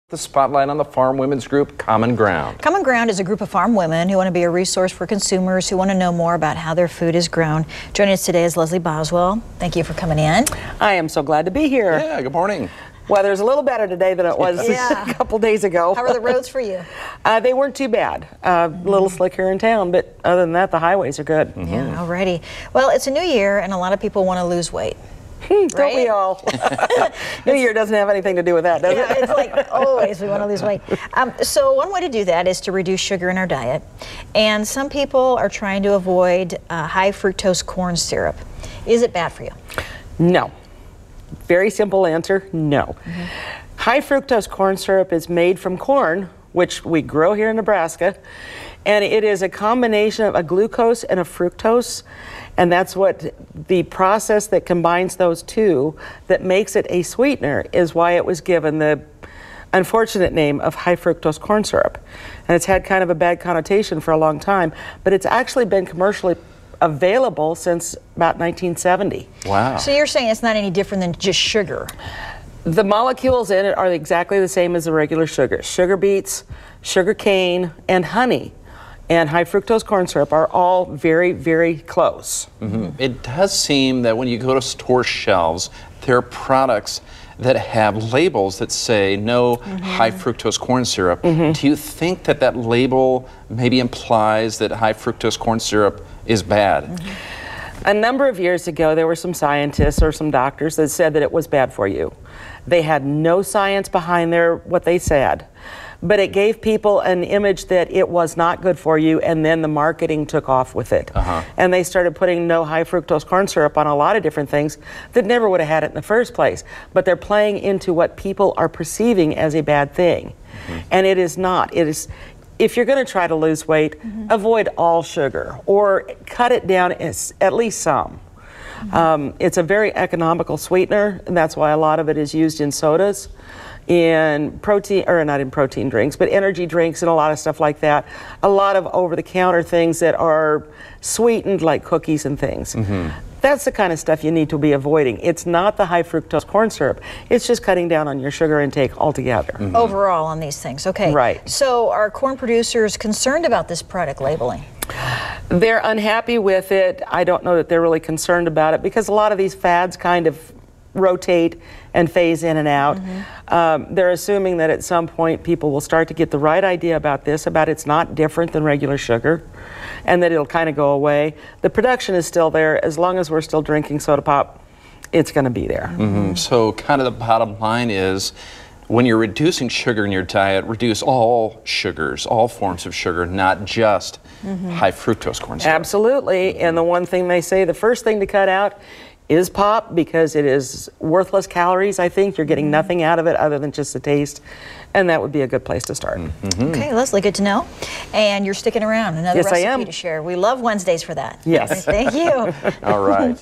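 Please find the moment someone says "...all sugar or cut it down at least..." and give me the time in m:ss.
2:04.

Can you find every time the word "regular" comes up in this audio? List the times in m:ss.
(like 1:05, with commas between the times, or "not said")
1:14, 2:48.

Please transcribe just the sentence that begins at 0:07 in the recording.
Joining us today is Leslie Boswell.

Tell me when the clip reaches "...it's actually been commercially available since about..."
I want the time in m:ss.
1:05.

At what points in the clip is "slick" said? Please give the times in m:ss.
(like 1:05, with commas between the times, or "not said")
0:19.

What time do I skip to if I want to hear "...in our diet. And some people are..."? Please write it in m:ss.
0:33.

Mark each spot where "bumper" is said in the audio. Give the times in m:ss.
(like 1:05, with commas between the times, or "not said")
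not said.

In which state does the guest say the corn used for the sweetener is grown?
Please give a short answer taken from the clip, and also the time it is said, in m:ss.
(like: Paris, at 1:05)
Nebraska, at 0:47.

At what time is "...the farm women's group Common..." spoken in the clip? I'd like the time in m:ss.
0:00.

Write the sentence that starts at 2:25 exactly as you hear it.
It's not the high fructose corn syrup.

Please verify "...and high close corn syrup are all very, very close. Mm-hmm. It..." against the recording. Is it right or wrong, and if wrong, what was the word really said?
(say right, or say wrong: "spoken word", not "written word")
wrong: "fructose", not "close".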